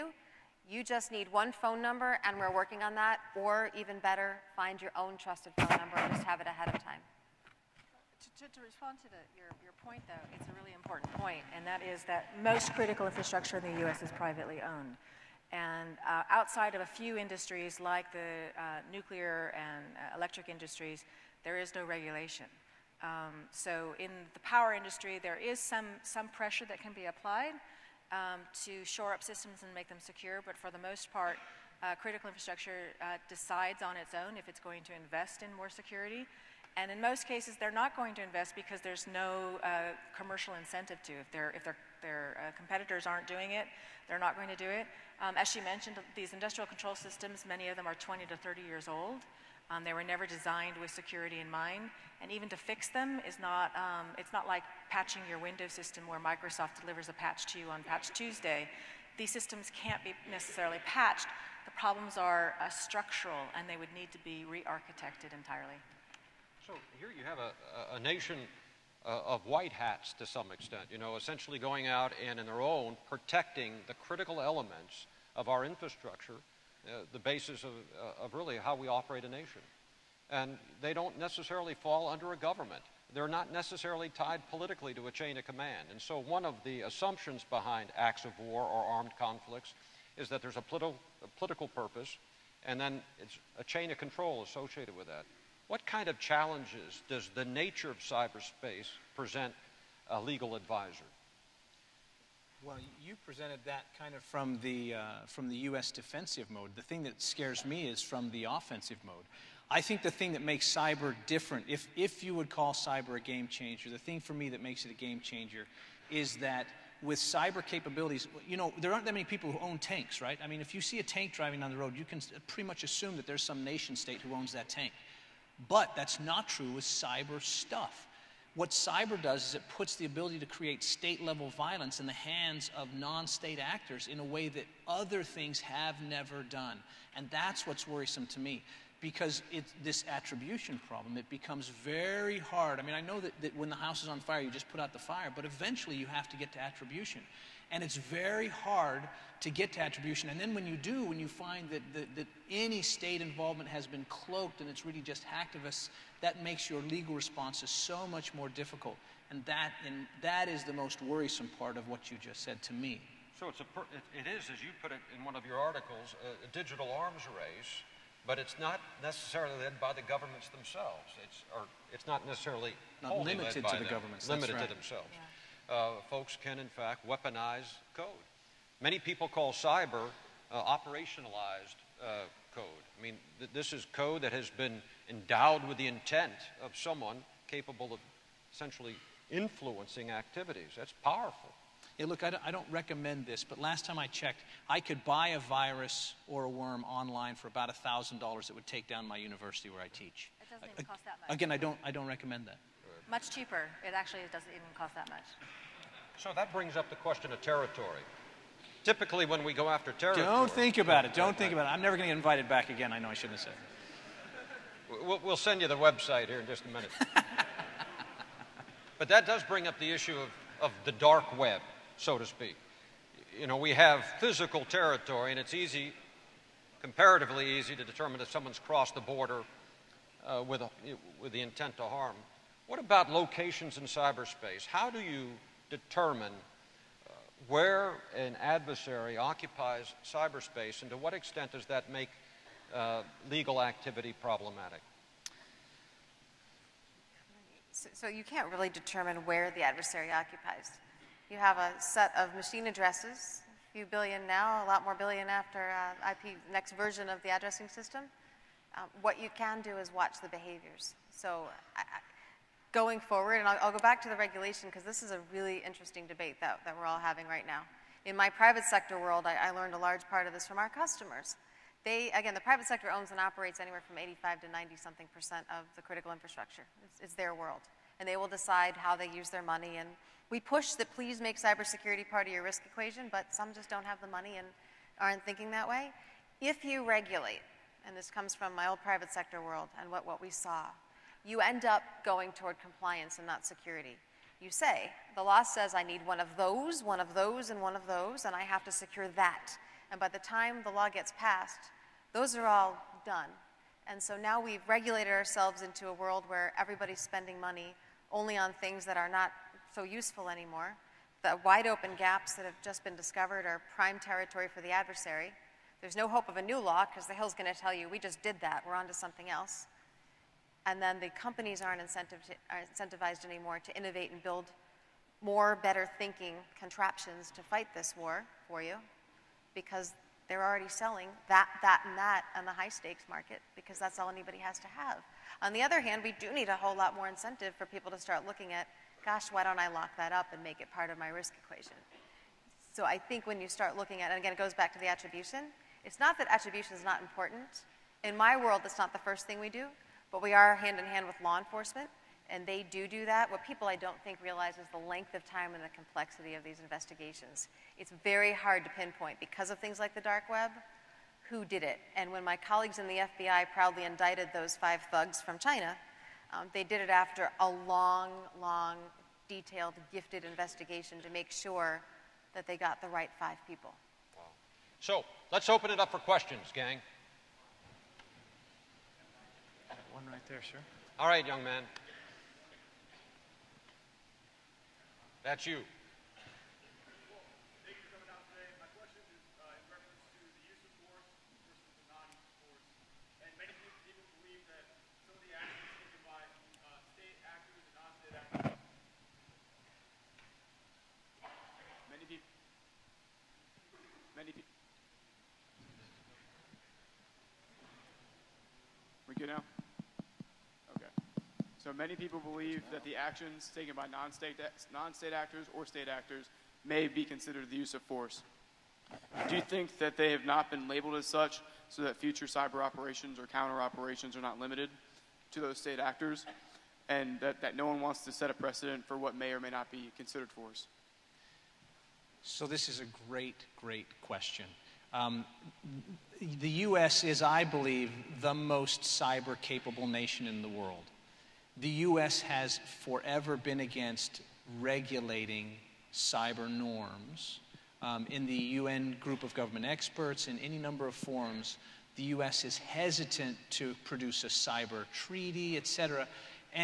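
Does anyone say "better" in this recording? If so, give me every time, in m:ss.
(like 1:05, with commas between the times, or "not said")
0:03, 5:25.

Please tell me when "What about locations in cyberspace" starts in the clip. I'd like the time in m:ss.
3:52.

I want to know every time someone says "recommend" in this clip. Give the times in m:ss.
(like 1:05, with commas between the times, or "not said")
3:12, 3:22.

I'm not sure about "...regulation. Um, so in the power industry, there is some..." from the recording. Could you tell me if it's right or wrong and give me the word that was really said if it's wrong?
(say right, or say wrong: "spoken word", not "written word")
right.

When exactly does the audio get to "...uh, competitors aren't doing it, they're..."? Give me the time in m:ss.
0:42.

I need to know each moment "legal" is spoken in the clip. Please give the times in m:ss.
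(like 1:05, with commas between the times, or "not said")
1:40, 2:36, 4:03.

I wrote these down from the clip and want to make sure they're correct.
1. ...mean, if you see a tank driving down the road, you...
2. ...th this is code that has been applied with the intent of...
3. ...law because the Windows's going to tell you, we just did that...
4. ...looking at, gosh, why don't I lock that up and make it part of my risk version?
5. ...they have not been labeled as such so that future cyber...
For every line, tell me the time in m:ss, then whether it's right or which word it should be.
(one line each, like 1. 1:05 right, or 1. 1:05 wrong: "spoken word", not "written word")
1. 2:00 right
2. 3:03 wrong: "endowed", not "applied"
3. 5:16 wrong: "Hill", not "Windows"
4. 5:38 wrong: "equation", not "version"
5. 6:59 right.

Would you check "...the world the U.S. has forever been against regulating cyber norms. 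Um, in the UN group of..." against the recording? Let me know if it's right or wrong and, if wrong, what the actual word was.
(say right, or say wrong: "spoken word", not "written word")
right.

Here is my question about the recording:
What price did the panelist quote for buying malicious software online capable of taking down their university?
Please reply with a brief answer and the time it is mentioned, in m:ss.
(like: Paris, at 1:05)
$1,000, at 3:17.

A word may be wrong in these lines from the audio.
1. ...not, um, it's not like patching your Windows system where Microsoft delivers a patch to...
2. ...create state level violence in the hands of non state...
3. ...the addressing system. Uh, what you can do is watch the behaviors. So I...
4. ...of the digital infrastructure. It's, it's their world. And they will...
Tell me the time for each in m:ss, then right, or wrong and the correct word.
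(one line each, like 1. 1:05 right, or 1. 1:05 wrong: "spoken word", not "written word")
1. 0:53 right
2. 2:10 right
3. 4:17 right
4. 4:35 wrong: "critical", not "digital".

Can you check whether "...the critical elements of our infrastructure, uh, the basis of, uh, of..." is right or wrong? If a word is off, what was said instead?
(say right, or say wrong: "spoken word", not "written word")
right.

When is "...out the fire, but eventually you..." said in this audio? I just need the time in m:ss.
2:24.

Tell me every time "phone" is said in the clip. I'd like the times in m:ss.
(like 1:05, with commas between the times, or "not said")
0:01, 0:05.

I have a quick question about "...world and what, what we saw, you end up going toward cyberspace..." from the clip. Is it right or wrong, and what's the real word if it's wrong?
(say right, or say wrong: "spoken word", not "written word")
wrong: "compliance", not "cyberspace".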